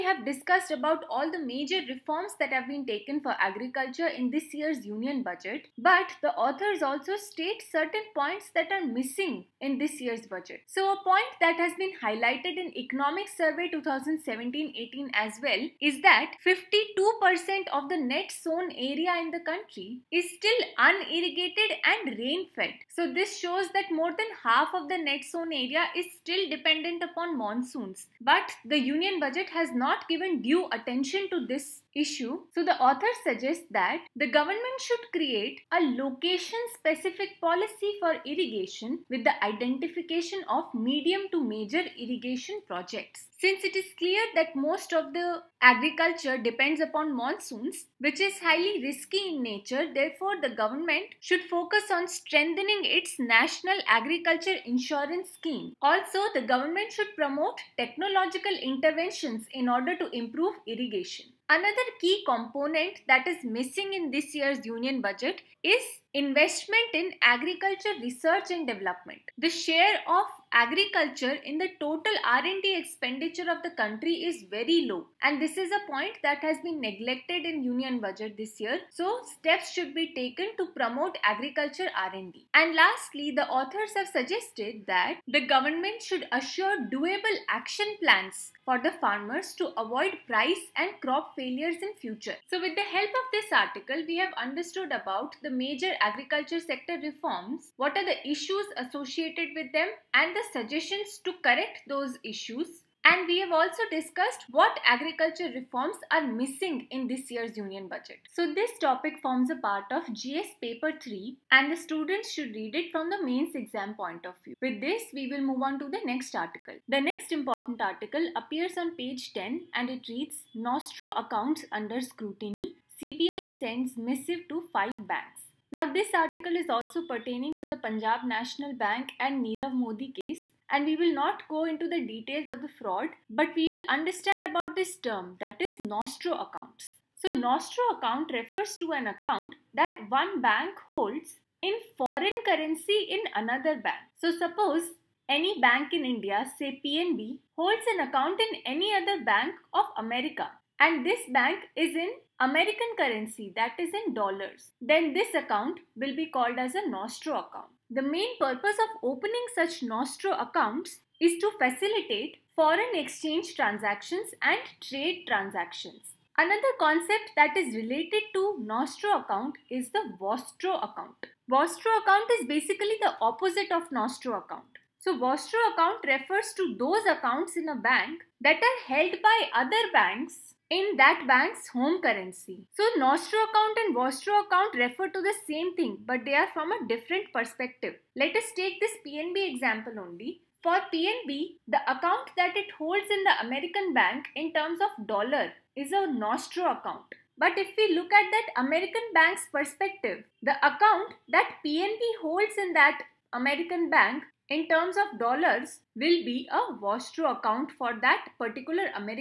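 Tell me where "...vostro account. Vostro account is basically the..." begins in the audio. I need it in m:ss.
2:50.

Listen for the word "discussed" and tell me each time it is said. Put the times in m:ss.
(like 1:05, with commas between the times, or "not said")
0:00, 1:43.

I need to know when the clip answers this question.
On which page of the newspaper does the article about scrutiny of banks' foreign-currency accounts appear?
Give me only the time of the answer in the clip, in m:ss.
1:59.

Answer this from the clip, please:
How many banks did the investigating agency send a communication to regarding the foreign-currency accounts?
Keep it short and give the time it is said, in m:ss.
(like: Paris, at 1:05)
5, at 2:04.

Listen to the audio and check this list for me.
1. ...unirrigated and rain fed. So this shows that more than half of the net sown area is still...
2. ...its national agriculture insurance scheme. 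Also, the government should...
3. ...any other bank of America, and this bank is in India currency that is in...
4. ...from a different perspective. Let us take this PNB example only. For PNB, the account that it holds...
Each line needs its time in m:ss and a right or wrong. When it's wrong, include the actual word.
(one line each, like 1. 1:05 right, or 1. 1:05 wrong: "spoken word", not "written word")
1. 0:20 right
2. 0:52 right
3. 2:28 wrong: "American", not "India"
4. 3:06 right.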